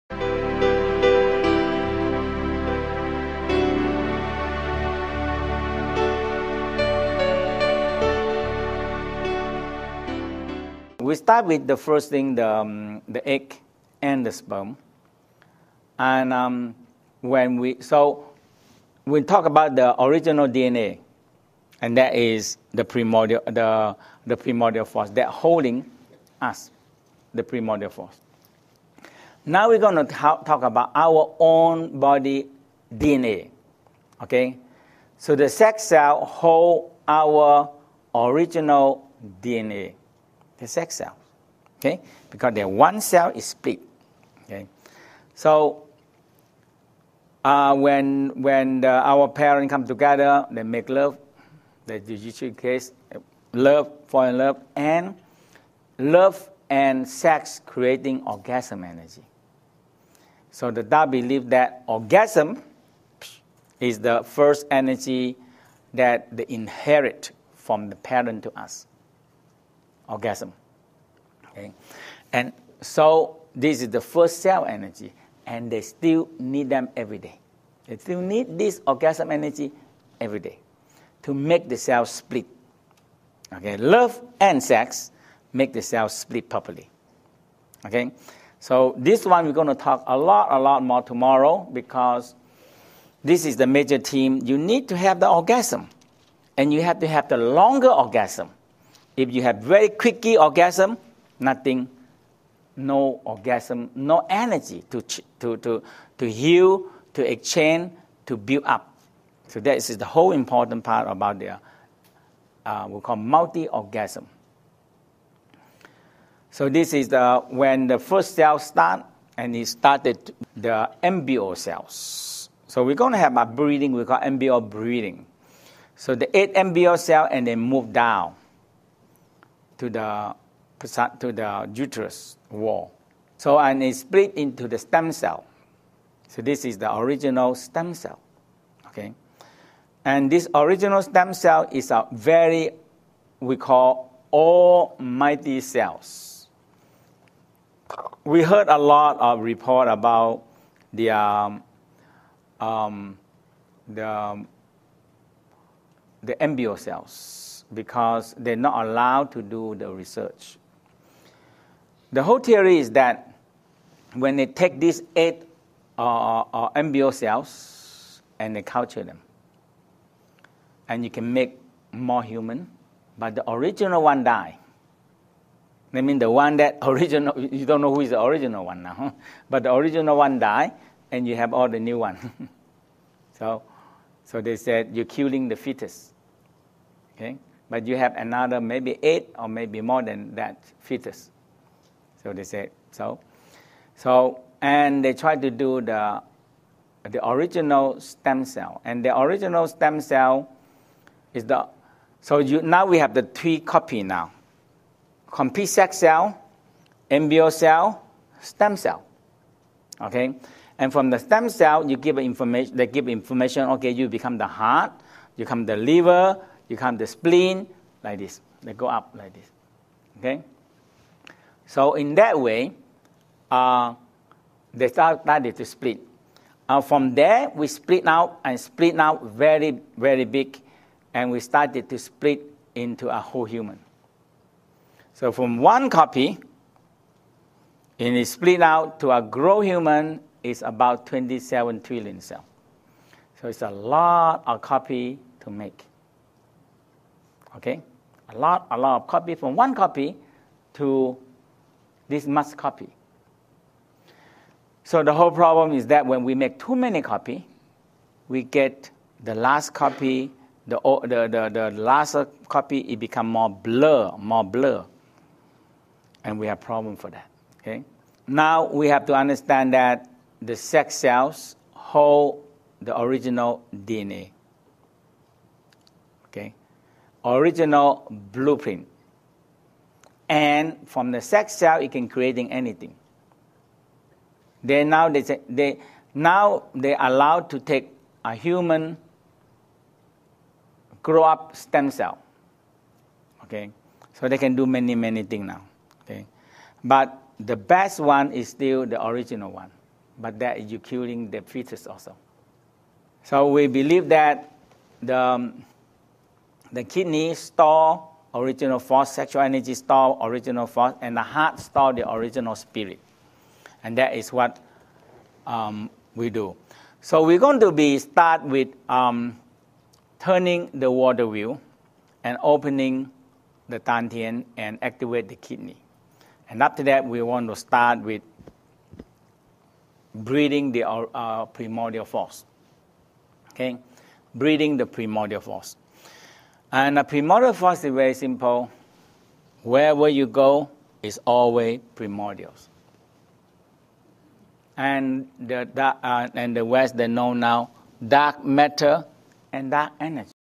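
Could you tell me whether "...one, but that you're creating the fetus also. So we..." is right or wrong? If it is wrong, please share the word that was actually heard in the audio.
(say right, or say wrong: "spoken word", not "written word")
wrong: "killing", not "creating".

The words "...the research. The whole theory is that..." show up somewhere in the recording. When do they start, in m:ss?
2:39.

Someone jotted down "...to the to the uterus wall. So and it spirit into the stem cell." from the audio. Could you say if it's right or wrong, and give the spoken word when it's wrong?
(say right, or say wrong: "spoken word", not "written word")
wrong: "split", not "spirit".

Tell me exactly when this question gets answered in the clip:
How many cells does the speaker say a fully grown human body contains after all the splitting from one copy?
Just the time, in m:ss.
4:01.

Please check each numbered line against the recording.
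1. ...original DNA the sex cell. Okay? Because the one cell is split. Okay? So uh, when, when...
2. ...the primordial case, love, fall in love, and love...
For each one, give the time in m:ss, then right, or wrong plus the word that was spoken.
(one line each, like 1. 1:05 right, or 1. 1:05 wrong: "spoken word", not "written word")
1. 0:38 right
2. 0:51 wrong: "judicial", not "primordial".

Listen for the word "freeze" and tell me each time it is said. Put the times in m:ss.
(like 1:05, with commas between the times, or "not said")
not said.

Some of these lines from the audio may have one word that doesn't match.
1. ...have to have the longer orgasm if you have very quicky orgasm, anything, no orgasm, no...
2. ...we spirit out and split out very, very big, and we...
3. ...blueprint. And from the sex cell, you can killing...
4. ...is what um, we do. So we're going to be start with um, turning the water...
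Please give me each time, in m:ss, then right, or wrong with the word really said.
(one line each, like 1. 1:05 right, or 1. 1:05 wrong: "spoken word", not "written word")
1. 1:36 wrong: "nothing", not "anything"
2. 3:47 wrong: "split", not "spirit"
3. 4:38 wrong: "creating", not "killing"
4. 5:14 right.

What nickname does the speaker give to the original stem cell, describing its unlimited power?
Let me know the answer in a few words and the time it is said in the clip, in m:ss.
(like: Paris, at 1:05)
Almighty cells, at 2:24.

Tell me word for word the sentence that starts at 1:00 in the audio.
So the Tao believe that orgasm is the first energy that they inherit from the parent to us orgasm.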